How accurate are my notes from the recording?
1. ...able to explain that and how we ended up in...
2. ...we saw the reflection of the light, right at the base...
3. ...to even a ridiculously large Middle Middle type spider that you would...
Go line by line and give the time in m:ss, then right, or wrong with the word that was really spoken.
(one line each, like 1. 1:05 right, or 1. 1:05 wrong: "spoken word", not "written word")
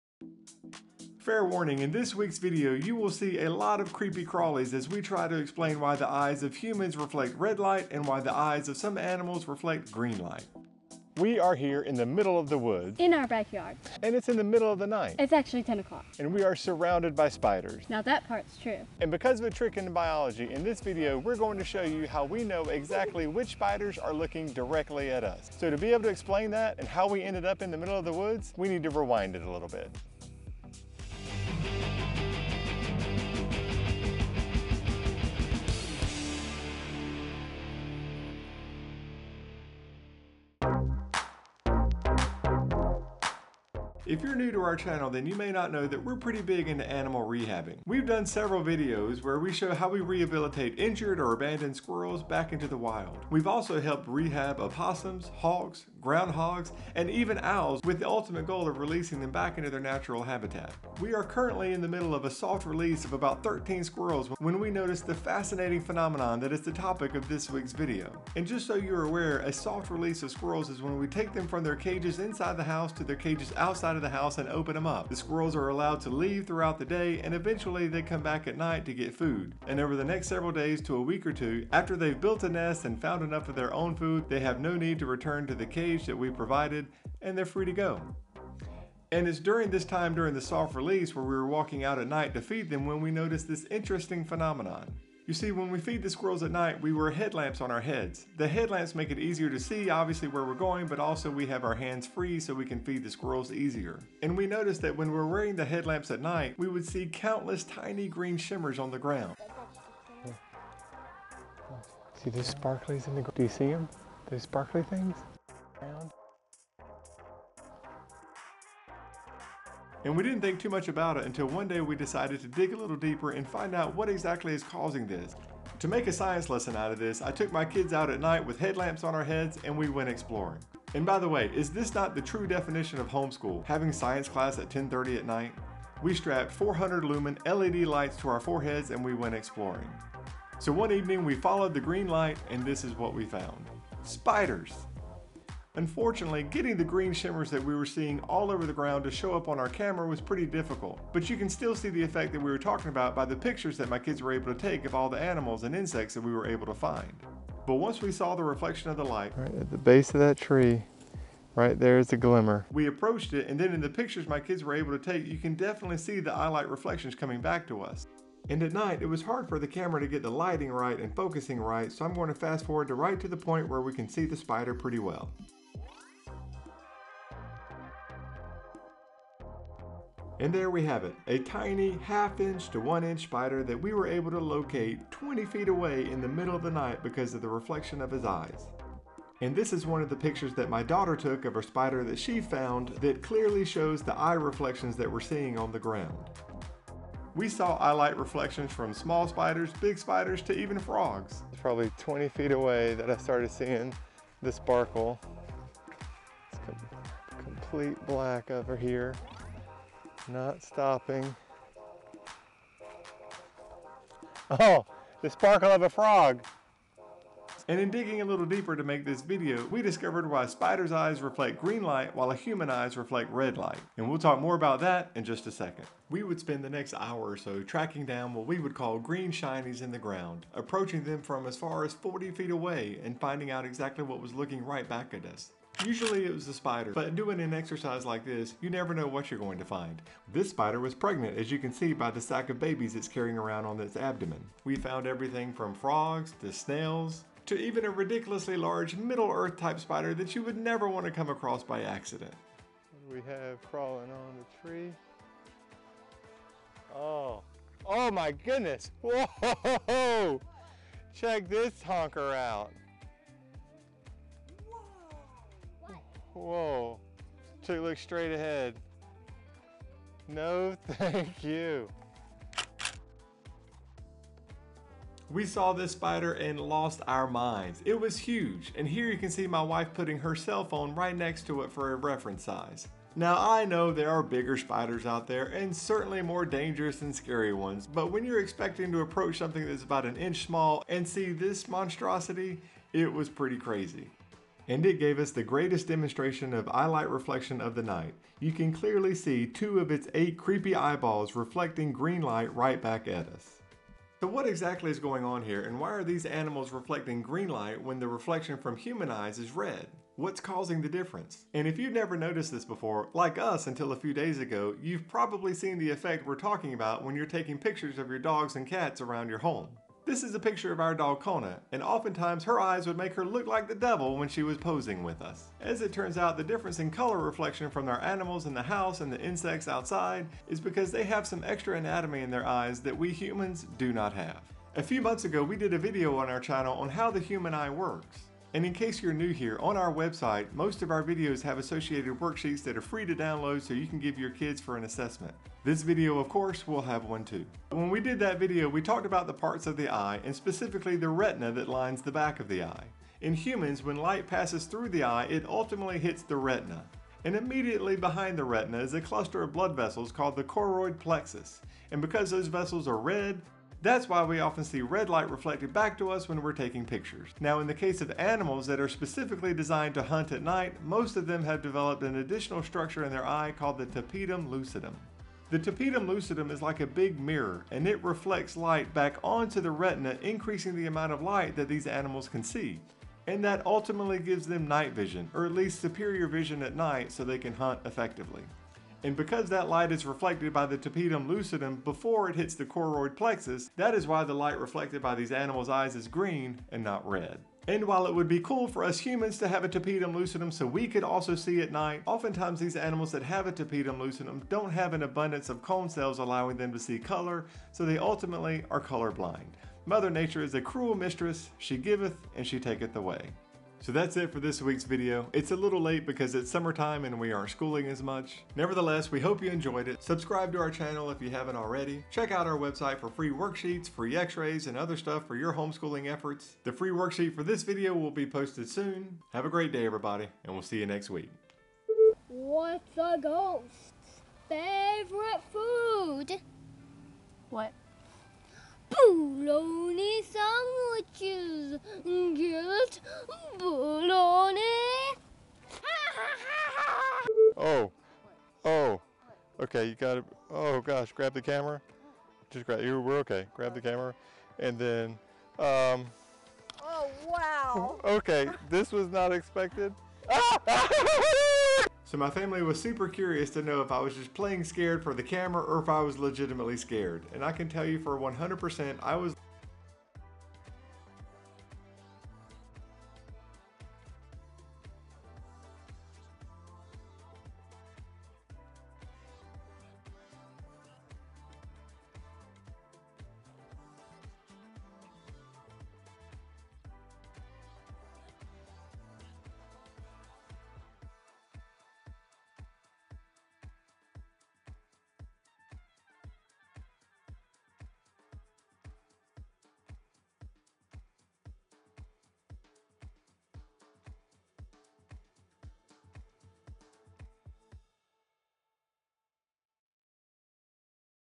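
1. 0:25 right
2. 2:38 right
3. 4:07 wrong: "Earth", not "Middle".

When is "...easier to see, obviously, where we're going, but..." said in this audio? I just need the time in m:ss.
1:39.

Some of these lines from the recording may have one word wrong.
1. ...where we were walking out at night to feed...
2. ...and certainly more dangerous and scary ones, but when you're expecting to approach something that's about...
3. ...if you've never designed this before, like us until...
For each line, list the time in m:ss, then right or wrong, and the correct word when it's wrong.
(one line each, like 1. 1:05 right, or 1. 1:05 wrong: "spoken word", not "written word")
1. 1:31 right
2. 4:45 right
3. 5:11 wrong: "noticed", not "designed".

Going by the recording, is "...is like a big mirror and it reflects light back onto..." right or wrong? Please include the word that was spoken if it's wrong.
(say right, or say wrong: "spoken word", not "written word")
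right.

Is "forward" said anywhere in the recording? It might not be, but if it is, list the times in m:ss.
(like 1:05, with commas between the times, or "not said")
2:52.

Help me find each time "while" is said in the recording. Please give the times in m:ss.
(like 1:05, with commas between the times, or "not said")
3:42, 6:37.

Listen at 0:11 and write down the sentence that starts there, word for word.
We are here in the middle of the woods.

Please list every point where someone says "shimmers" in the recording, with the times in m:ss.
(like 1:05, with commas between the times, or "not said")
1:48, 2:27.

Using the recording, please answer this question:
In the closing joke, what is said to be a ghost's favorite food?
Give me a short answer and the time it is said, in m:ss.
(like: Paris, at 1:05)
bologna sandwiches, at 7:18.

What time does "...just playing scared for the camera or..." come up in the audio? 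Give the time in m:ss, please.
7:44.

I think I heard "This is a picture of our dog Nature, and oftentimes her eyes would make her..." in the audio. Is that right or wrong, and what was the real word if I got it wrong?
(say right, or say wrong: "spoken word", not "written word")
wrong: "Kona", not "Nature".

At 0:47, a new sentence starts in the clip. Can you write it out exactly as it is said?
We've done several videos where we show how we rehabilitate injured or abandoned squirrels back into the wild.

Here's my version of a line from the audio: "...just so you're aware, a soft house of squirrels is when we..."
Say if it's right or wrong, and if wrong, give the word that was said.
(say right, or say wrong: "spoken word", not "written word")
wrong: "release", not "house".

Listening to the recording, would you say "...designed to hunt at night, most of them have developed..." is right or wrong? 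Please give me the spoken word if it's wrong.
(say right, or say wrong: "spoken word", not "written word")
right.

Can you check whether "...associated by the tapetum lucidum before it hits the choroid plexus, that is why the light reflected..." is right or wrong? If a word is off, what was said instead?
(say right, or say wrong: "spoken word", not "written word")
wrong: "reflected", not "associated".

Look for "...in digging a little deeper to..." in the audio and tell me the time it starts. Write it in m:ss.
3:37.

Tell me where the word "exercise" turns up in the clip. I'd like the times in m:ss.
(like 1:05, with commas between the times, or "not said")
3:57.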